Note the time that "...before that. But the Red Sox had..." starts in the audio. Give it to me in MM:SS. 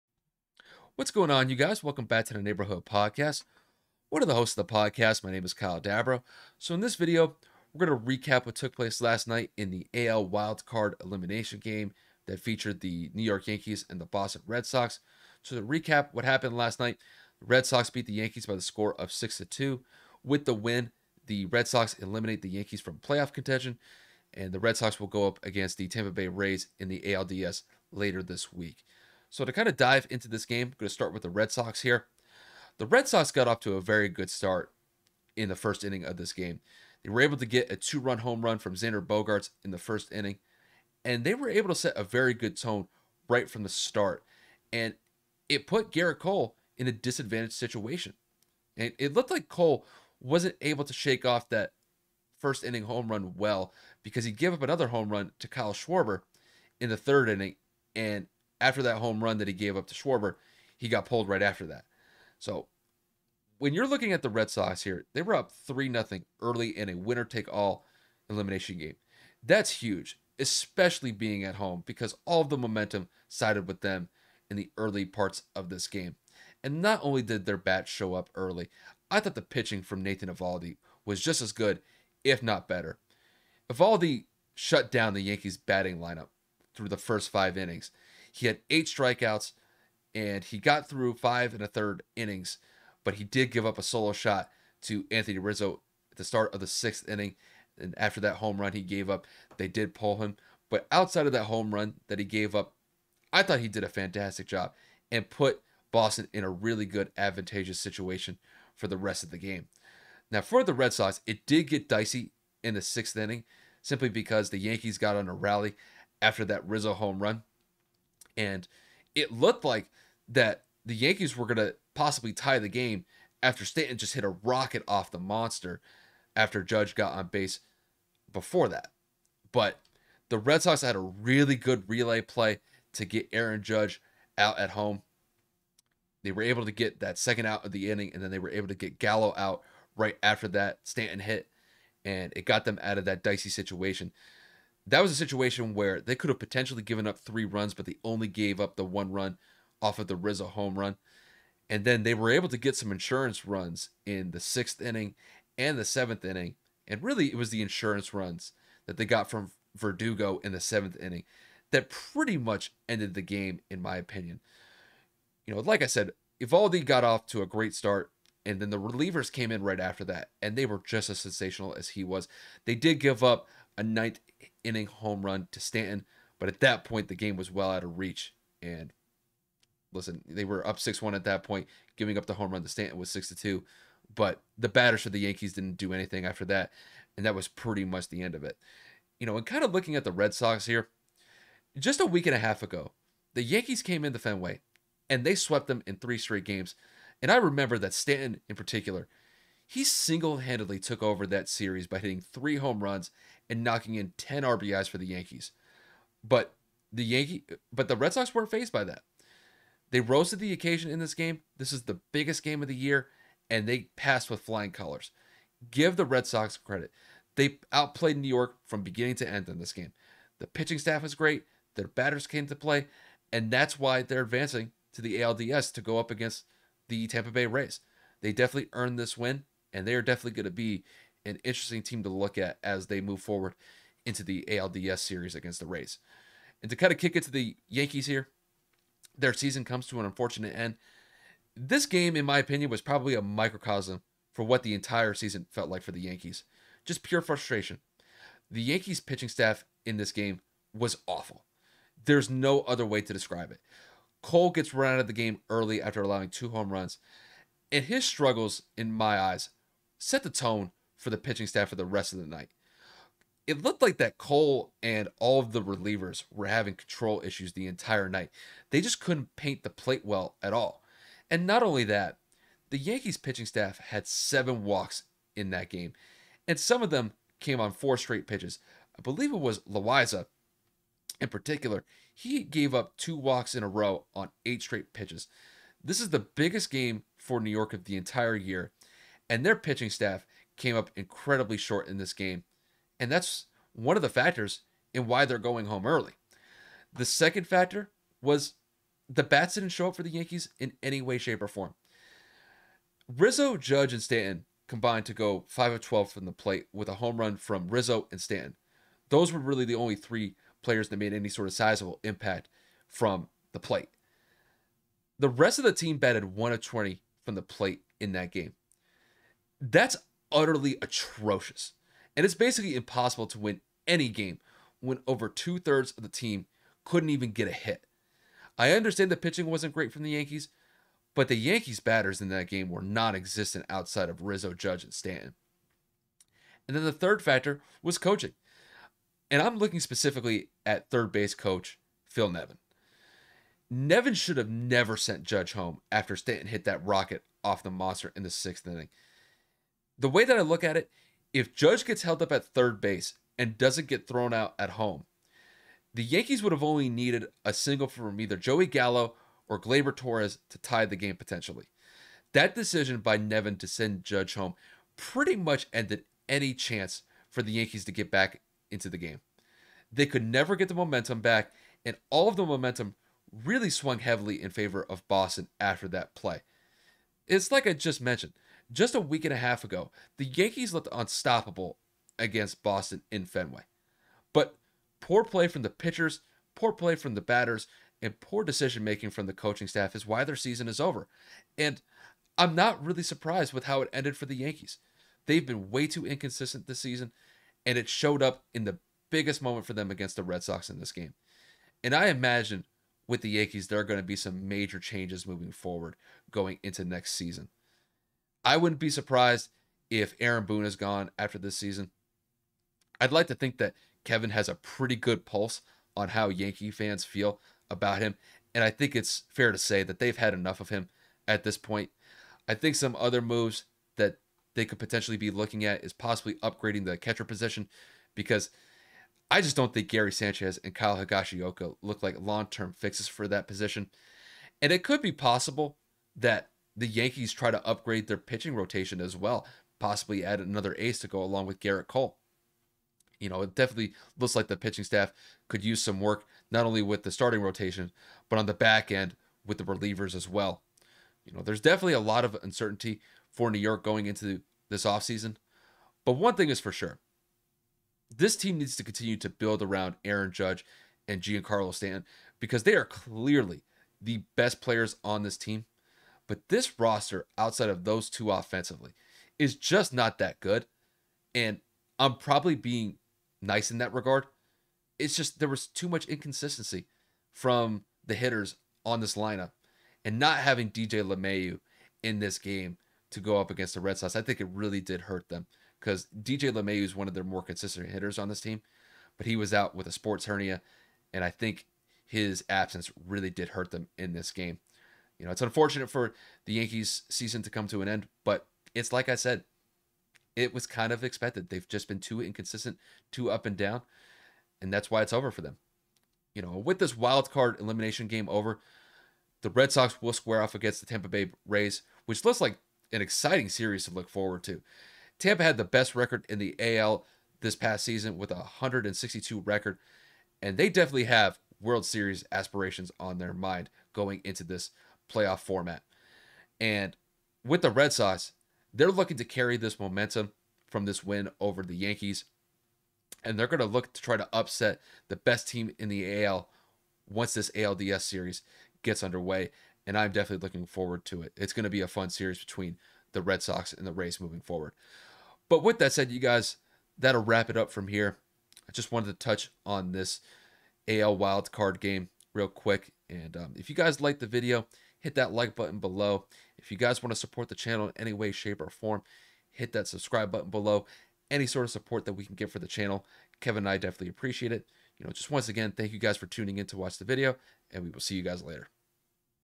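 02:08.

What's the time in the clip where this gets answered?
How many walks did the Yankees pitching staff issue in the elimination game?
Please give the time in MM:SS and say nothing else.
04:34.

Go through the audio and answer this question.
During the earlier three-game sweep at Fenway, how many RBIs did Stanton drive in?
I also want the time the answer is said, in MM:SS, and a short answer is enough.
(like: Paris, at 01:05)
10, at 03:24.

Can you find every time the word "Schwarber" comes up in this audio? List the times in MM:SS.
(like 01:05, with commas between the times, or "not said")
00:55, 00:59.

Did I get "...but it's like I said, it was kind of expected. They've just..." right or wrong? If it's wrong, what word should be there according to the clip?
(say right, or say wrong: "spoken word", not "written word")
right.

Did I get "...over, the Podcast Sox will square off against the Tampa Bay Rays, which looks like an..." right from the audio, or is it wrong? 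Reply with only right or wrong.
wrong.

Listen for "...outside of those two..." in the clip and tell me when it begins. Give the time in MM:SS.
07:47.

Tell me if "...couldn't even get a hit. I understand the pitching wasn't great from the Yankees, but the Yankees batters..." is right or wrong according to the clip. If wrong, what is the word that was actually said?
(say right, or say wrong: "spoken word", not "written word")
right.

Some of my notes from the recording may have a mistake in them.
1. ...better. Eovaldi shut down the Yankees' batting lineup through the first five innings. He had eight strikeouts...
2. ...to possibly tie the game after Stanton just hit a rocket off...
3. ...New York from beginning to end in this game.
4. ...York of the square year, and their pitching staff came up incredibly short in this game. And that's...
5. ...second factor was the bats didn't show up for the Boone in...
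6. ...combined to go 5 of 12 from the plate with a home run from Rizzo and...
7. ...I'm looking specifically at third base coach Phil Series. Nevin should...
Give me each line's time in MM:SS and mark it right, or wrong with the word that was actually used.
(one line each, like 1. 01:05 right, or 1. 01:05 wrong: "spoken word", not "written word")
1. 01:22 right
2. 02:01 right
3. 03:38 right
4. 04:47 wrong: "entire", not "square"
5. 04:57 wrong: "Yankees", not "Boone"
6. 05:04 right
7. 05:39 wrong: "Nevin", not "Series".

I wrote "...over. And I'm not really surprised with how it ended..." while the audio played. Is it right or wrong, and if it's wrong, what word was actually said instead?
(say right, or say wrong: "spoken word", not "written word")
right.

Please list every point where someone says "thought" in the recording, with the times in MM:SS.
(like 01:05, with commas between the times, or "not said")
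01:19, 01:43.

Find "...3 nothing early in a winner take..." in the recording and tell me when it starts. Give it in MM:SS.
01:05.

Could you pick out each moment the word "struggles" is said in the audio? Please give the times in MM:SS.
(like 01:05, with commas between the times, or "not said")
04:18.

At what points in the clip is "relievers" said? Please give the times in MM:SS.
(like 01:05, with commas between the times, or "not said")
02:48, 04:25, 07:29.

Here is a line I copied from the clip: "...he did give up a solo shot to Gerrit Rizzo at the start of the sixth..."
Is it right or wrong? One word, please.
wrong.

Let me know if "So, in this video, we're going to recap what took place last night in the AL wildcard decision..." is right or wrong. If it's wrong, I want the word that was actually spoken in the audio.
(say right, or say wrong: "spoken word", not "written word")
wrong: "elimination", not "decision".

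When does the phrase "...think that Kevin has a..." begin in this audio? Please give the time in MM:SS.
06:53.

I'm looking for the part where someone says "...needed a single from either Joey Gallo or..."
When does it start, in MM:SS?
05:56.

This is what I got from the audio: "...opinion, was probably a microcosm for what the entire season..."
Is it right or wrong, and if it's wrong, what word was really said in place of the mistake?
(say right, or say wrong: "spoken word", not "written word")
right.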